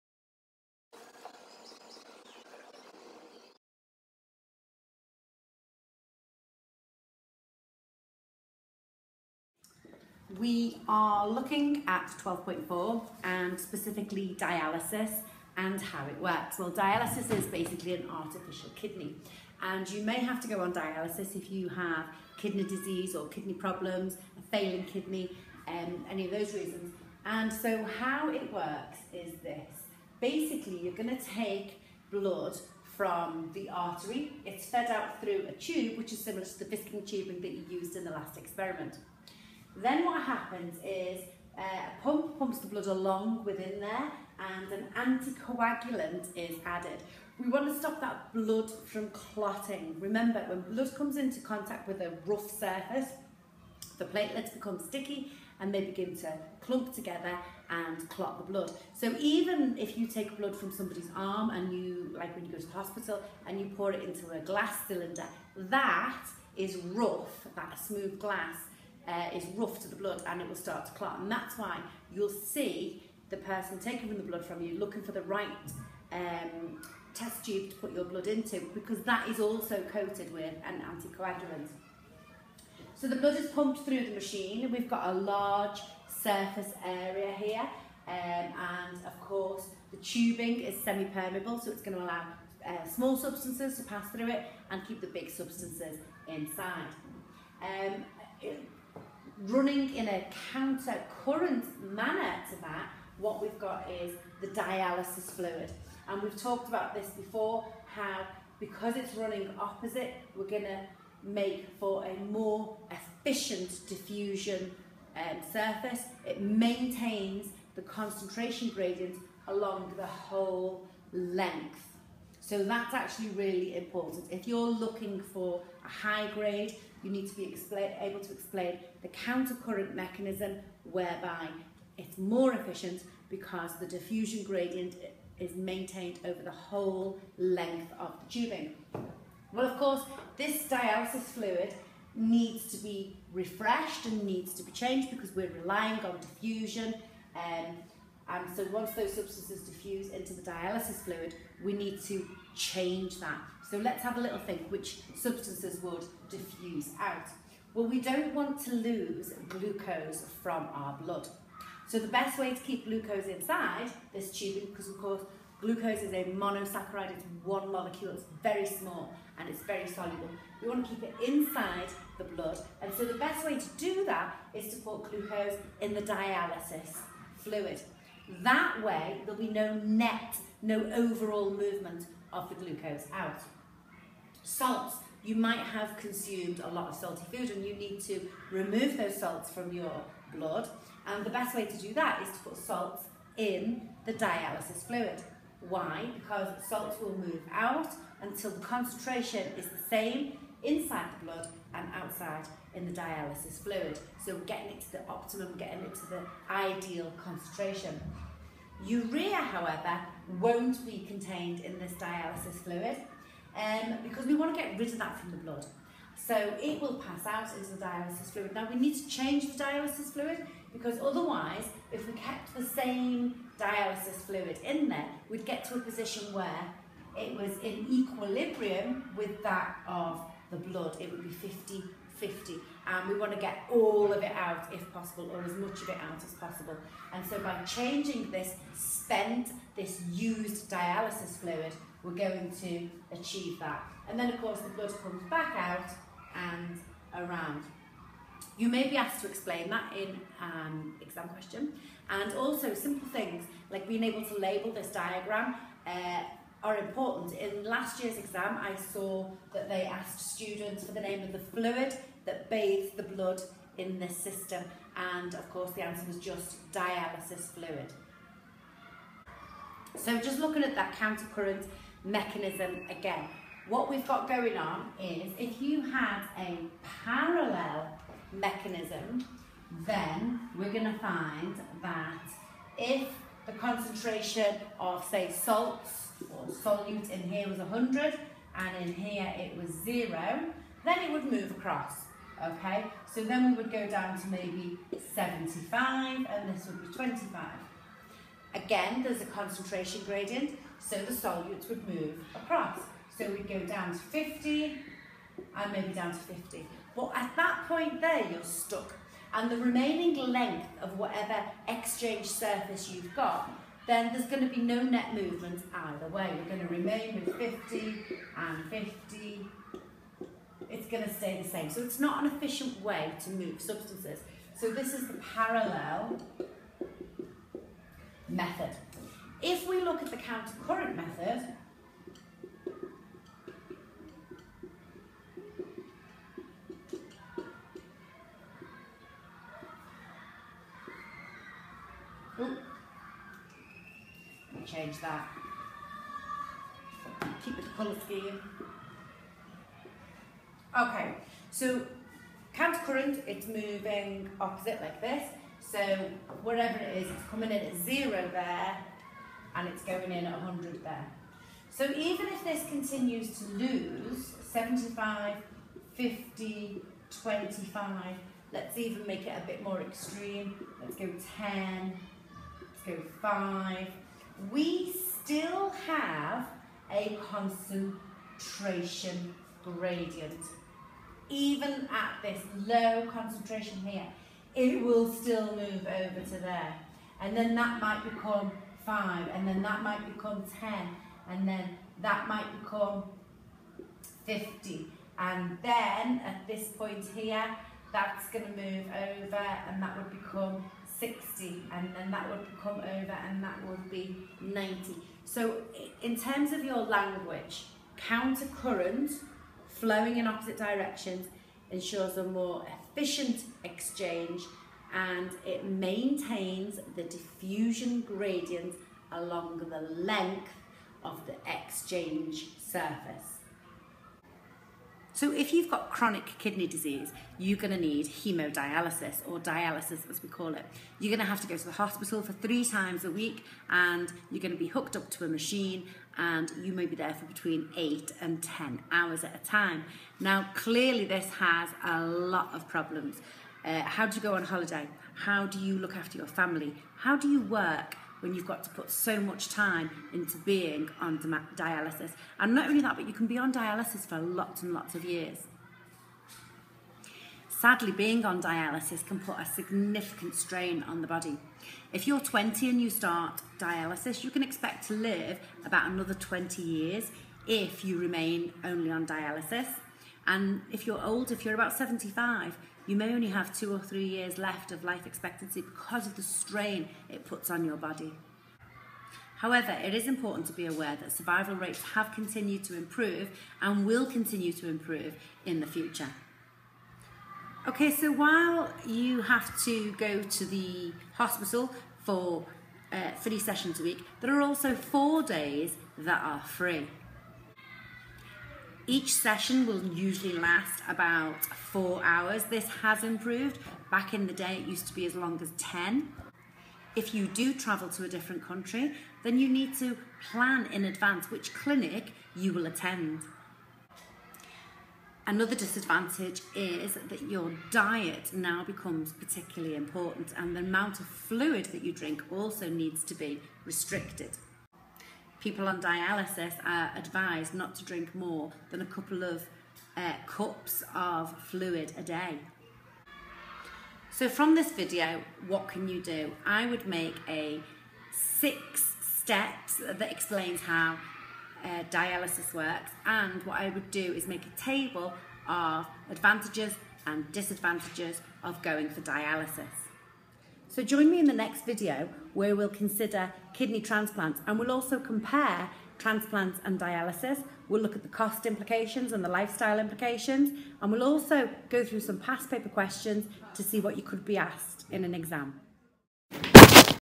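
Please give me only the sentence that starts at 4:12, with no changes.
And also simple things like being able to label this diagram uh, are important.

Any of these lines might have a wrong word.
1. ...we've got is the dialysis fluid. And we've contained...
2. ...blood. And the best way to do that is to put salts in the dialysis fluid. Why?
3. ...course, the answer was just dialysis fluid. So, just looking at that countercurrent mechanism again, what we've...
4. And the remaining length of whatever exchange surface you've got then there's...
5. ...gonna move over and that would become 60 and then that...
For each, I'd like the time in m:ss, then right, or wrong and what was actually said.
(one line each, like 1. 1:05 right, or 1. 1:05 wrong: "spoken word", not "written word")
1. 1:43 wrong: "talked", not "contained"
2. 3:10 right
3. 4:25 right
4. 5:09 right
5. 6:38 right.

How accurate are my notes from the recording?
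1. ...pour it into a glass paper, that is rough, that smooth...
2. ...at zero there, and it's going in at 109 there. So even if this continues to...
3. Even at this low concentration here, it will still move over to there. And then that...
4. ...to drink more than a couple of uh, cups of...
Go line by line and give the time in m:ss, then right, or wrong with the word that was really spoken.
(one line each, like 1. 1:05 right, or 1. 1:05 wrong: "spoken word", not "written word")
1. 1:03 wrong: "cylinder", not "paper"
2. 5:57 wrong: "100", not "109"
3. 6:21 right
4. 8:47 right.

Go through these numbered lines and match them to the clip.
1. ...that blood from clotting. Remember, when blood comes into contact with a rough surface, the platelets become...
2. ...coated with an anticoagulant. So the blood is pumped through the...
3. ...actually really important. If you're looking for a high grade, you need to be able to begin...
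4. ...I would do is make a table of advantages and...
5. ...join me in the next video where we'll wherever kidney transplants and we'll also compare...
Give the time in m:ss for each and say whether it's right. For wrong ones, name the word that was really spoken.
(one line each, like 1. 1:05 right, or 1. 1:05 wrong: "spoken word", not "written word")
1. 0:48 right
2. 1:19 right
3. 2:02 wrong: "explain", not "begin"
4. 9:03 right
5. 9:10 wrong: "consider", not "wherever".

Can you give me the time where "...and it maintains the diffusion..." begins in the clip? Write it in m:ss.
6:54.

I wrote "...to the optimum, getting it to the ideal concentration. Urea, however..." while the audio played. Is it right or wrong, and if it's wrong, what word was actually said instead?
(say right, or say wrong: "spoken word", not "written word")
right.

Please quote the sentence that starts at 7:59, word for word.
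However, it is important to be aware that survival rates have continued to improve and will continue to improve in the future.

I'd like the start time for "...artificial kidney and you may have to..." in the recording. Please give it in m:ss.
0:18.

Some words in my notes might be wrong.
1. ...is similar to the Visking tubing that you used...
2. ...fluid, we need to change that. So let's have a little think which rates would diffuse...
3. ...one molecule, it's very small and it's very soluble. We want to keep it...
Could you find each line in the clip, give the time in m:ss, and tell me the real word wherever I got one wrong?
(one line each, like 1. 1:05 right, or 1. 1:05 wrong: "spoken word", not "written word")
1. 0:36 right
2. 2:31 wrong: "substances", not "rates"
3. 2:47 right.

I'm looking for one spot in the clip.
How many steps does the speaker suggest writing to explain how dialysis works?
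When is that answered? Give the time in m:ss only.
8:58.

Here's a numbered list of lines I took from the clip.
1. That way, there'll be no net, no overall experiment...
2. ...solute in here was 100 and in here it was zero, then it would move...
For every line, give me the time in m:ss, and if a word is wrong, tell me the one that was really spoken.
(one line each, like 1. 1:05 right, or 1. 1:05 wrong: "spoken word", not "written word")
1. 2:58 wrong: "movement", not "experiment"
2. 4:46 right.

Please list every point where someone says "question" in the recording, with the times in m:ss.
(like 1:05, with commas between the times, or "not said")
4:11, 9:22.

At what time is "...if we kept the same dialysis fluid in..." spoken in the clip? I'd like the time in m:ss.
3:41.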